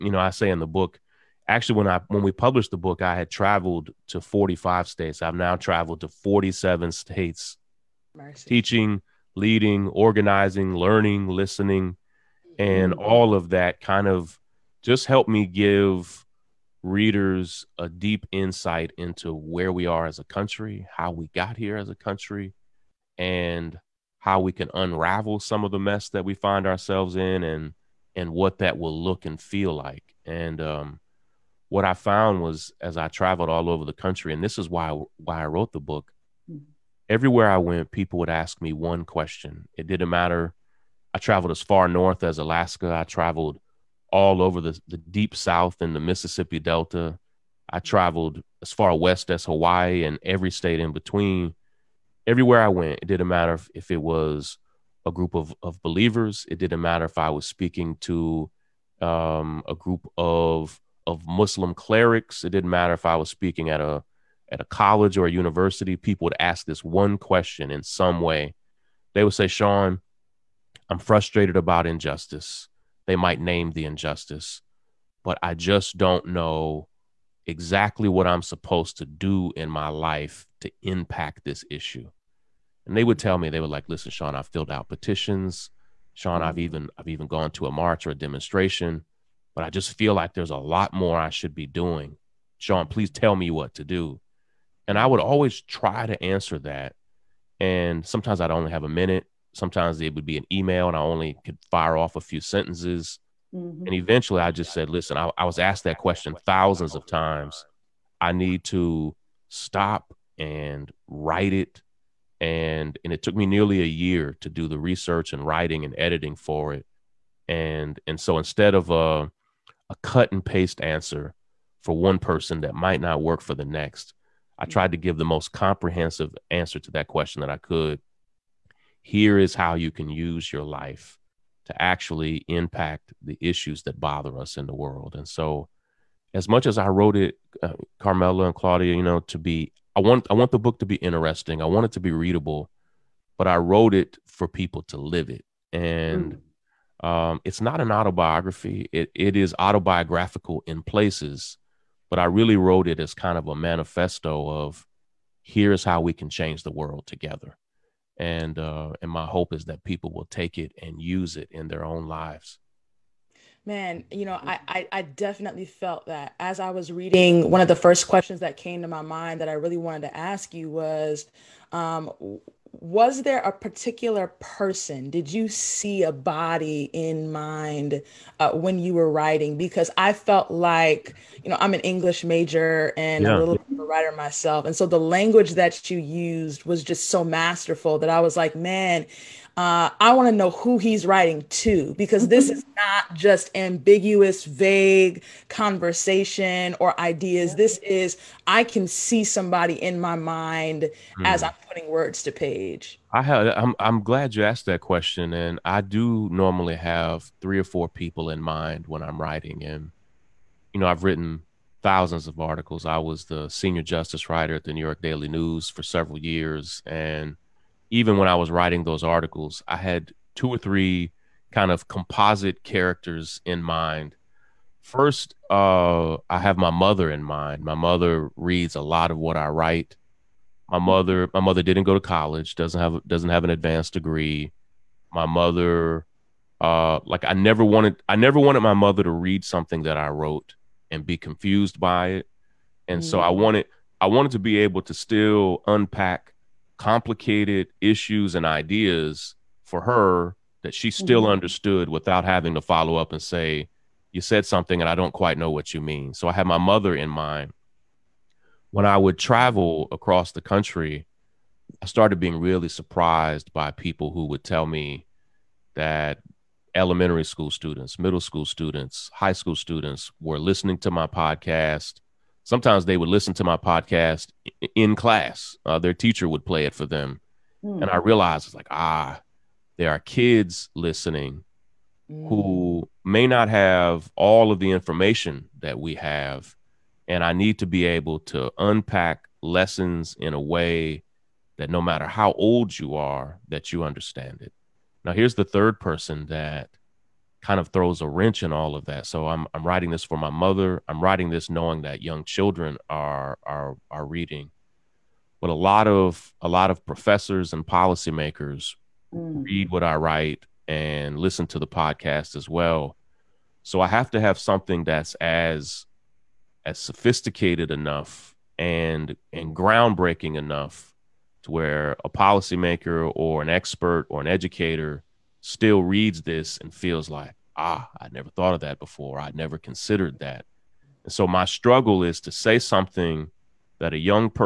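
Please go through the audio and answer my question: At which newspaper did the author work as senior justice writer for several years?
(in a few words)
New York Daily News.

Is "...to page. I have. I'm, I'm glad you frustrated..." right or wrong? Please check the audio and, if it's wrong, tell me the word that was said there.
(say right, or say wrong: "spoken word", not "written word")
wrong: "asked", not "frustrated".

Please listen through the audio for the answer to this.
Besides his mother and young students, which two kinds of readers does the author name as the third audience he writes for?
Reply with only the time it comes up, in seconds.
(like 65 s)
306 s.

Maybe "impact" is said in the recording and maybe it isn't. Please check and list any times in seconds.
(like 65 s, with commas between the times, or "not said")
80 s, 132 s.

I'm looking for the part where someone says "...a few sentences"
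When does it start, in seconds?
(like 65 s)
102 s.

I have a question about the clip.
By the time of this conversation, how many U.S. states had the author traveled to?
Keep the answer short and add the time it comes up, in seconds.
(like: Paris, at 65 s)
47, at 6 s.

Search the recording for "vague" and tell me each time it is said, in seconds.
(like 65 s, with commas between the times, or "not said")
194 s.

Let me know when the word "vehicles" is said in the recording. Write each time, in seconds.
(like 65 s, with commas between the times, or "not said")
not said.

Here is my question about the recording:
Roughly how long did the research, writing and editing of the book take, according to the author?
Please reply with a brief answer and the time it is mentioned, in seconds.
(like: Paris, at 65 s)
Nearly a year, at 113 s.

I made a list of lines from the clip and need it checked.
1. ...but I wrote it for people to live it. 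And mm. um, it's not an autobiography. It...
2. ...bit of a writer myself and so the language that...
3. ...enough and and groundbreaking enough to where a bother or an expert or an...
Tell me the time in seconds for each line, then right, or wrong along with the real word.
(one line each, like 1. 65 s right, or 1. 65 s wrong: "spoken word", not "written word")
1. 143 s right
2. 183 s right
3. 317 s wrong: "policymaker", not "bother".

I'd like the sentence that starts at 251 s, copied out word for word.
understood without having to follow up and say, You said something and I don't quite know what you mean.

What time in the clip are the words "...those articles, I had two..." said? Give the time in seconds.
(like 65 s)
218 s.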